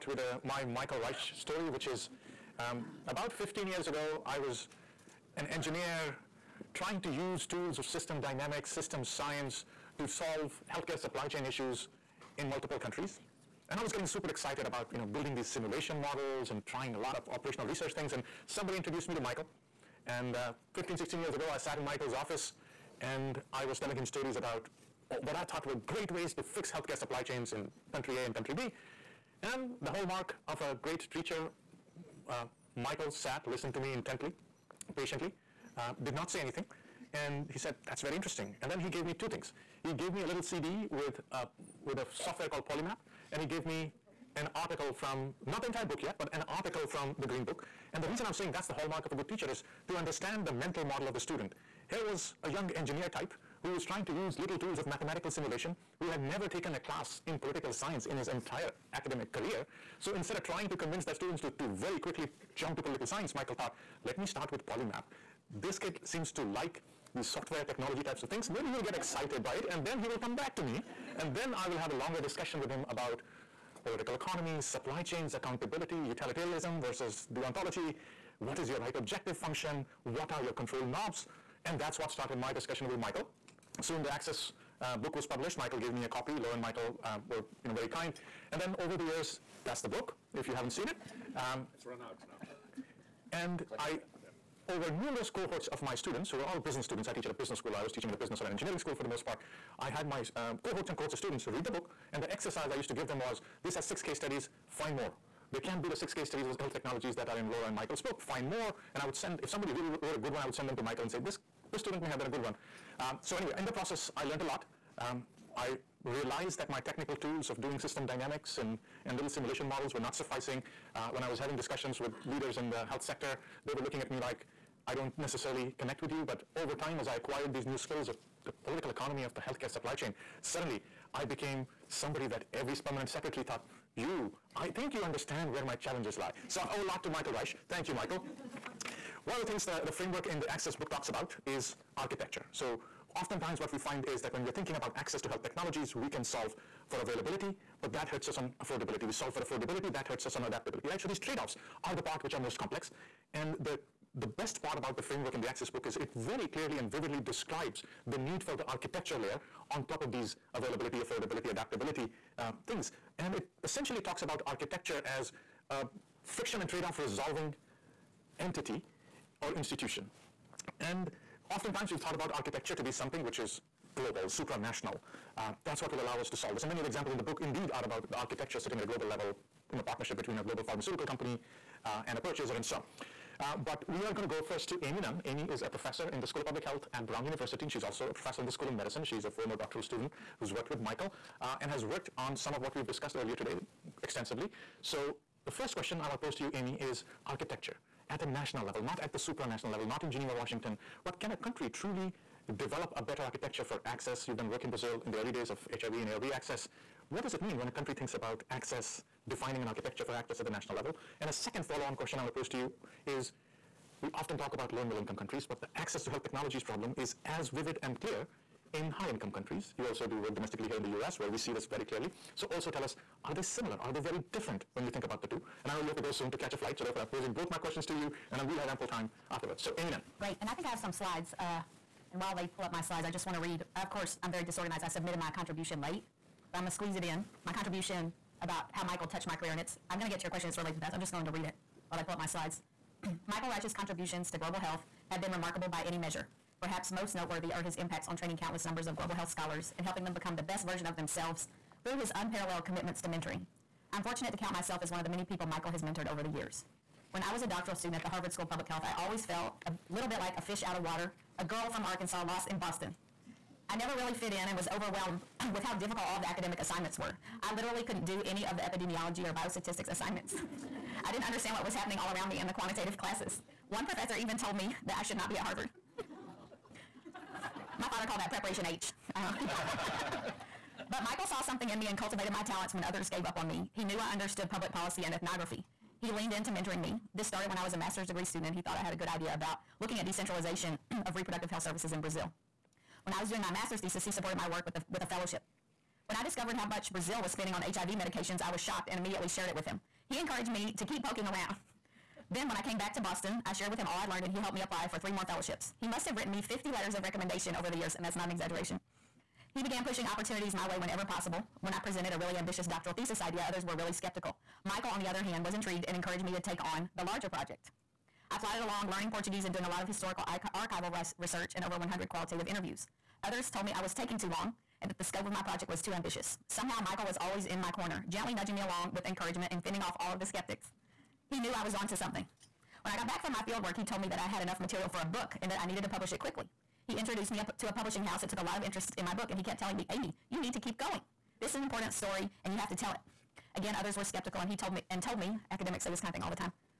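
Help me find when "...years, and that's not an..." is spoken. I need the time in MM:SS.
05:07.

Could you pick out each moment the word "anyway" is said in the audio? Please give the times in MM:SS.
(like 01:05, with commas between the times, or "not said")
01:53.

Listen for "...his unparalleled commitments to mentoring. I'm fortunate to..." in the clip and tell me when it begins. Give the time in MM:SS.
04:11.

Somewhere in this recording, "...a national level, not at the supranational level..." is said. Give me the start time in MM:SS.
03:18.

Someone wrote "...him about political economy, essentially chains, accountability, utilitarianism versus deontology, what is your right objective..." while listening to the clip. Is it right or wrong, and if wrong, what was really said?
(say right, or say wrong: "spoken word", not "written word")
wrong: "supply", not "essentially".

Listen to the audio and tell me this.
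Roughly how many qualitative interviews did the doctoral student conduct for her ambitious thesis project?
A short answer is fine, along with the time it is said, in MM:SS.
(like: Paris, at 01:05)
over 100, at 05:21.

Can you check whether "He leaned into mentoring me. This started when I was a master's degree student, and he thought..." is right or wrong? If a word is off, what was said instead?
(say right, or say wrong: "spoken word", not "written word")
right.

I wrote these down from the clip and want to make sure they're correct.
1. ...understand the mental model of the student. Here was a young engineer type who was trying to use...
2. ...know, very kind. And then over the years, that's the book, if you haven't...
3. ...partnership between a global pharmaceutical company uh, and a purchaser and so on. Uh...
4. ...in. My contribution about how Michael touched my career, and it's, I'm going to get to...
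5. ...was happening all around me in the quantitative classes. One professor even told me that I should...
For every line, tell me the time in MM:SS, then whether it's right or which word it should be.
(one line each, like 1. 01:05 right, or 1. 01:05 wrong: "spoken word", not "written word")
1. 00:49 right
2. 01:27 right
3. 02:59 right
4. 03:57 right
5. 04:31 right.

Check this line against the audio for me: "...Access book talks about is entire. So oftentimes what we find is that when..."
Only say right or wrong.
wrong.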